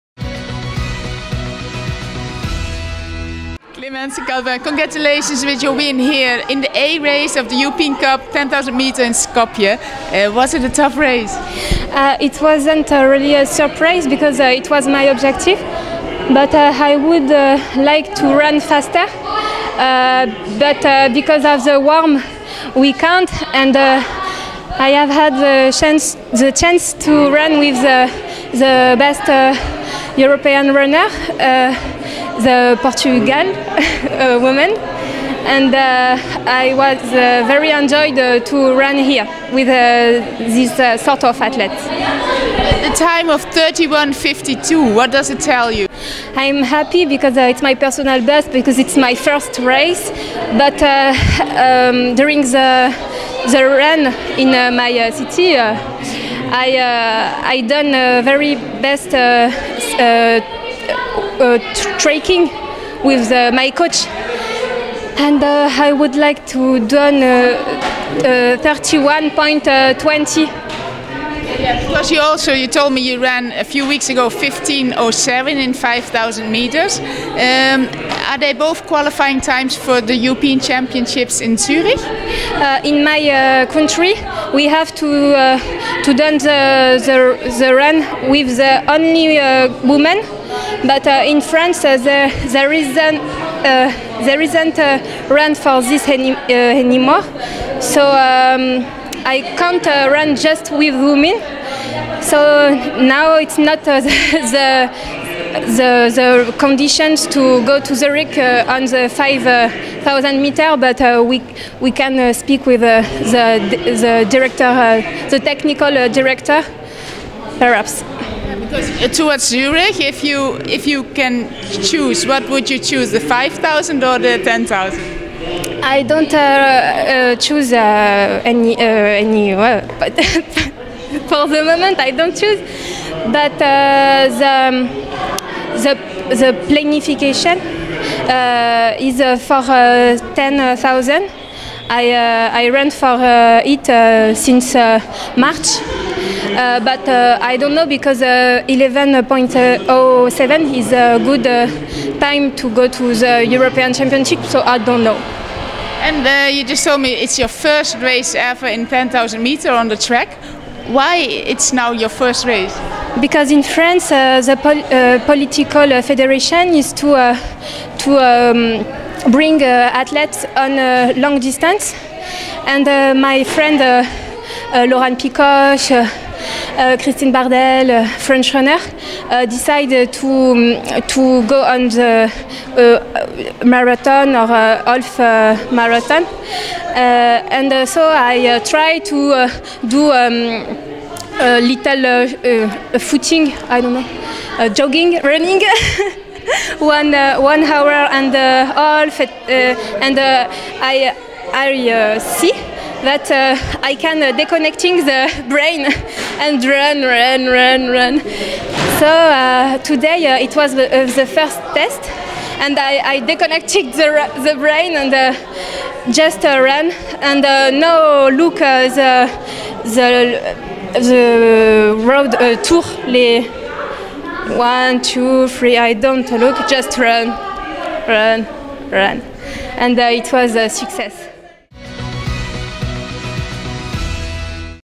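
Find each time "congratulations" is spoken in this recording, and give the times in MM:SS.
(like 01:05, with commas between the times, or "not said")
00:04.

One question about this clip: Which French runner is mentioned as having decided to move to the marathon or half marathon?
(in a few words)
Christine Bardelle.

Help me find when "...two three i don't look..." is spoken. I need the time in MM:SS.
03:45.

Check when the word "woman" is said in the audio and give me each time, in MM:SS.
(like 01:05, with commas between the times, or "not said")
00:34, 01:29.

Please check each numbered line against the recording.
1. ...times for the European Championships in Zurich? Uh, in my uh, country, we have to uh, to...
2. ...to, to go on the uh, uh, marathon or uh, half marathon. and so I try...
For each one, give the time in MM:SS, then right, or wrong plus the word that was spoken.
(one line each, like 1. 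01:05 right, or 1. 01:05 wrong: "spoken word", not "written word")
1. 01:19 right
2. 03:00 right.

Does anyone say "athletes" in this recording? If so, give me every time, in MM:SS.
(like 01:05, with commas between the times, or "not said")
00:41, 02:49.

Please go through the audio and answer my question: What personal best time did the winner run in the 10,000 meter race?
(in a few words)
31.52.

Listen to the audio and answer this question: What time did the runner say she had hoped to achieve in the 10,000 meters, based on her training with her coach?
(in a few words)
31.20.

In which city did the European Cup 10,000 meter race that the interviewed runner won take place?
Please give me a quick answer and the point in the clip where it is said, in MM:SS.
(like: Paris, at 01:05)
Skopje, at 00:09.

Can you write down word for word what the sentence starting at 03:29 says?
So today it was the, first test, and I, I disconnected the, the brain and just run.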